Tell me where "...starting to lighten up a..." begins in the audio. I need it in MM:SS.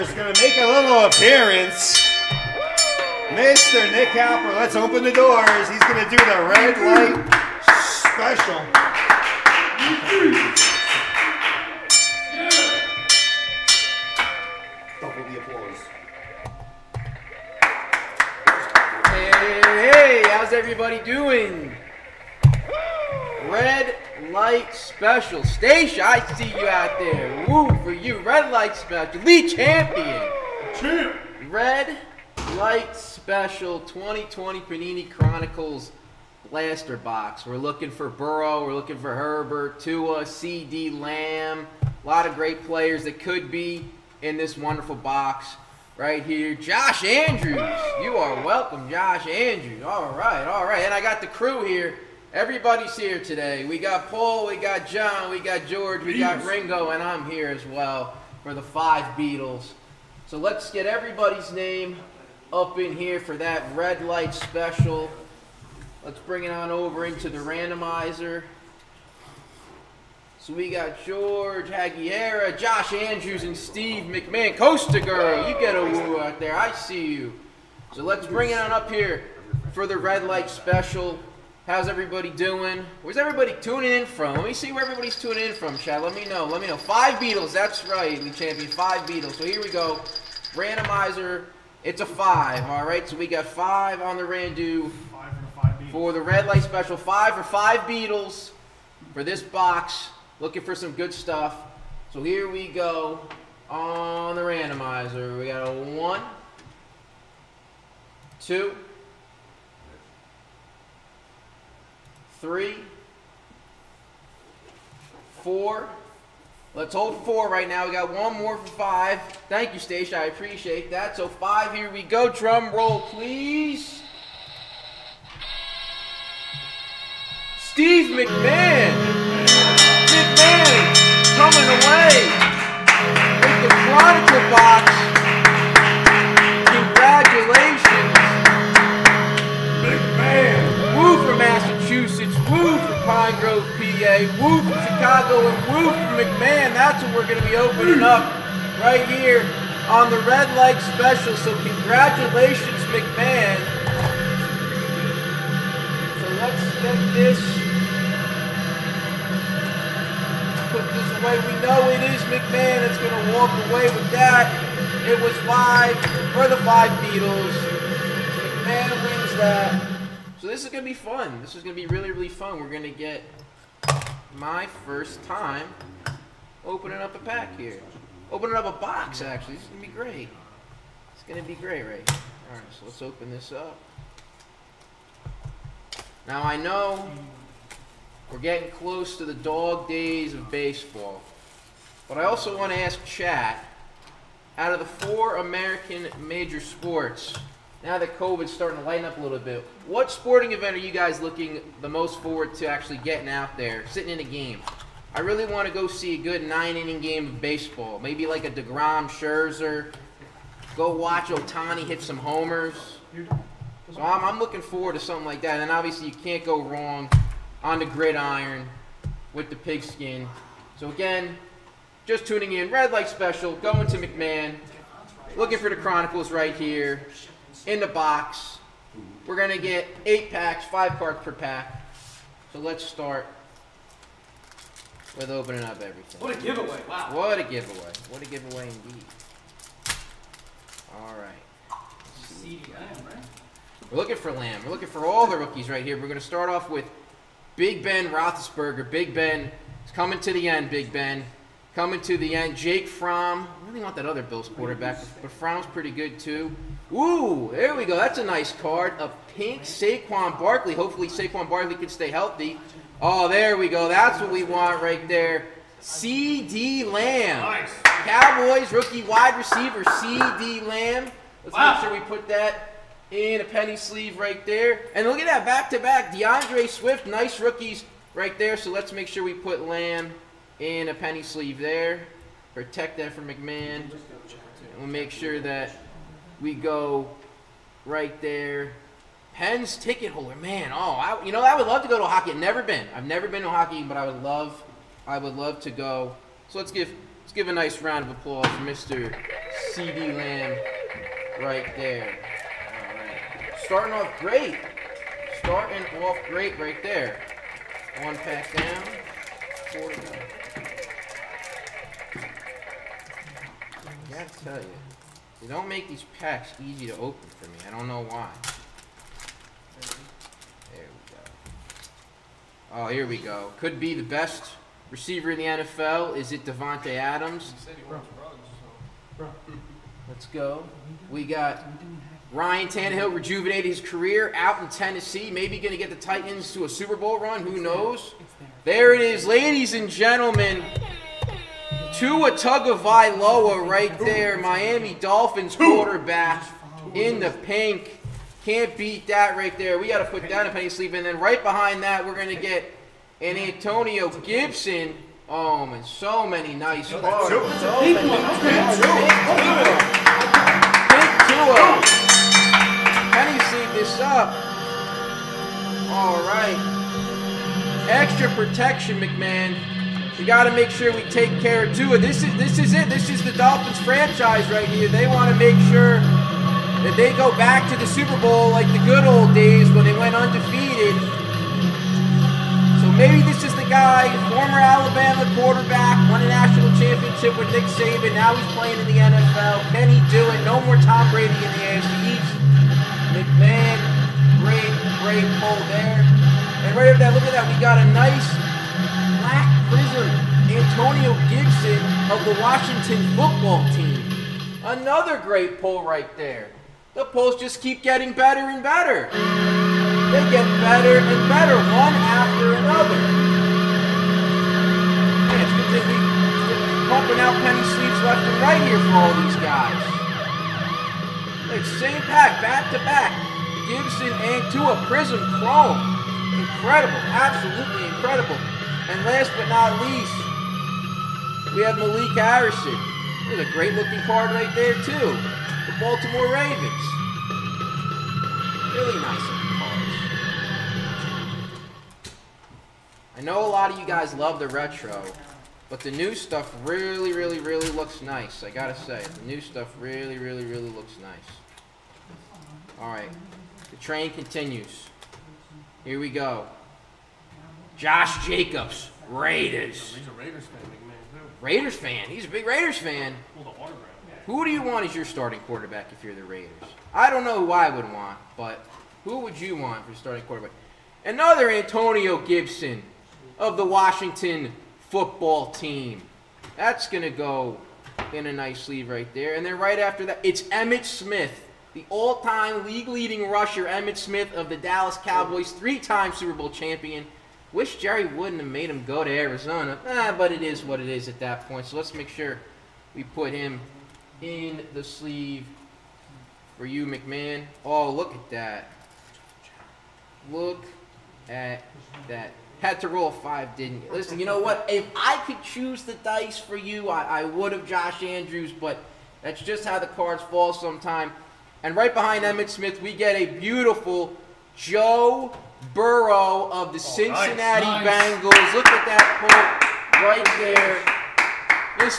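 03:18.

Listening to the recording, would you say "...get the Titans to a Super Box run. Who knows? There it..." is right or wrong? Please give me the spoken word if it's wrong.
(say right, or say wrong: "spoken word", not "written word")
wrong: "Bowl", not "Box".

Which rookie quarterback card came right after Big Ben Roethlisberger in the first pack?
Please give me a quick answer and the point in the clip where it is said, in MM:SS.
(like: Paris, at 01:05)
Jake Fromm, at 04:12.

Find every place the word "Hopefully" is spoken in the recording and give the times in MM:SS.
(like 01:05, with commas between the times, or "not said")
04:20.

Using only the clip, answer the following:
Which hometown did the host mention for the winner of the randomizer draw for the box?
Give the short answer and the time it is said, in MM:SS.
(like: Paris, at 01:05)
Grove, PA, at 02:23.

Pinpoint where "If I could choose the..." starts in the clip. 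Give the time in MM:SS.
08:24.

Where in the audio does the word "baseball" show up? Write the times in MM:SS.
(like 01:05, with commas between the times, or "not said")
03:10, 03:27.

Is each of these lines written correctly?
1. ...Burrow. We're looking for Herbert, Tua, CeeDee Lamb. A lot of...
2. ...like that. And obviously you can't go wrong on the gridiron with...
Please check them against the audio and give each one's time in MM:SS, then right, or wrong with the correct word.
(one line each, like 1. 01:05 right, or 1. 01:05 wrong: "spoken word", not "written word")
1. 00:38 right
2. 03:35 right.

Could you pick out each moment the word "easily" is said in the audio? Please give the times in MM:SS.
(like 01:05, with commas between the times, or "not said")
not said.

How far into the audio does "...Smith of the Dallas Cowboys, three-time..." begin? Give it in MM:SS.
08:03.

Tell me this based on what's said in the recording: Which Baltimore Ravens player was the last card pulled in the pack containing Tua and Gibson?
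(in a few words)
Malik Harrison.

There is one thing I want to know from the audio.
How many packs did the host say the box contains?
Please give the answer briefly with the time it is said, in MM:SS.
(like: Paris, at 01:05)
8, at 03:50.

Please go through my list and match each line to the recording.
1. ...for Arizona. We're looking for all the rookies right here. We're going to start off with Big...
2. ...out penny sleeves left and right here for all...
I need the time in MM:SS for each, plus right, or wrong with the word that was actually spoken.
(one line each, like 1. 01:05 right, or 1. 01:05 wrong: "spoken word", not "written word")
1. 04:04 wrong: "Lamb", not "Arizona"
2. 06:57 right.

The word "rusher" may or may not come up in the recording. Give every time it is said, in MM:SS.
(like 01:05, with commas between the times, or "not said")
08:03.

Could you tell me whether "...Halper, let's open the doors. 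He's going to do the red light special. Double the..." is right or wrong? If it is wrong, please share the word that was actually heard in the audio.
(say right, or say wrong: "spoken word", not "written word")
right.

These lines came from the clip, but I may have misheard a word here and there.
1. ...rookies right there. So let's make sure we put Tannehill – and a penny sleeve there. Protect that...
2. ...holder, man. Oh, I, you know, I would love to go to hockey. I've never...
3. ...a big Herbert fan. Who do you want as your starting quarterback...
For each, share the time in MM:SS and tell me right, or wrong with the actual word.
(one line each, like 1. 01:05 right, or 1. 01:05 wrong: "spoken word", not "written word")
1. 04:37 wrong: "Lamb", not "Tannehill"
2. 04:50 right
3. 07:42 wrong: "Raiders", not "Herbert".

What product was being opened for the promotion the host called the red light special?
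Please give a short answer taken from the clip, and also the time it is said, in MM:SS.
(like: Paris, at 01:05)
2020 Panini Chronicles Blaster Box, at 00:33.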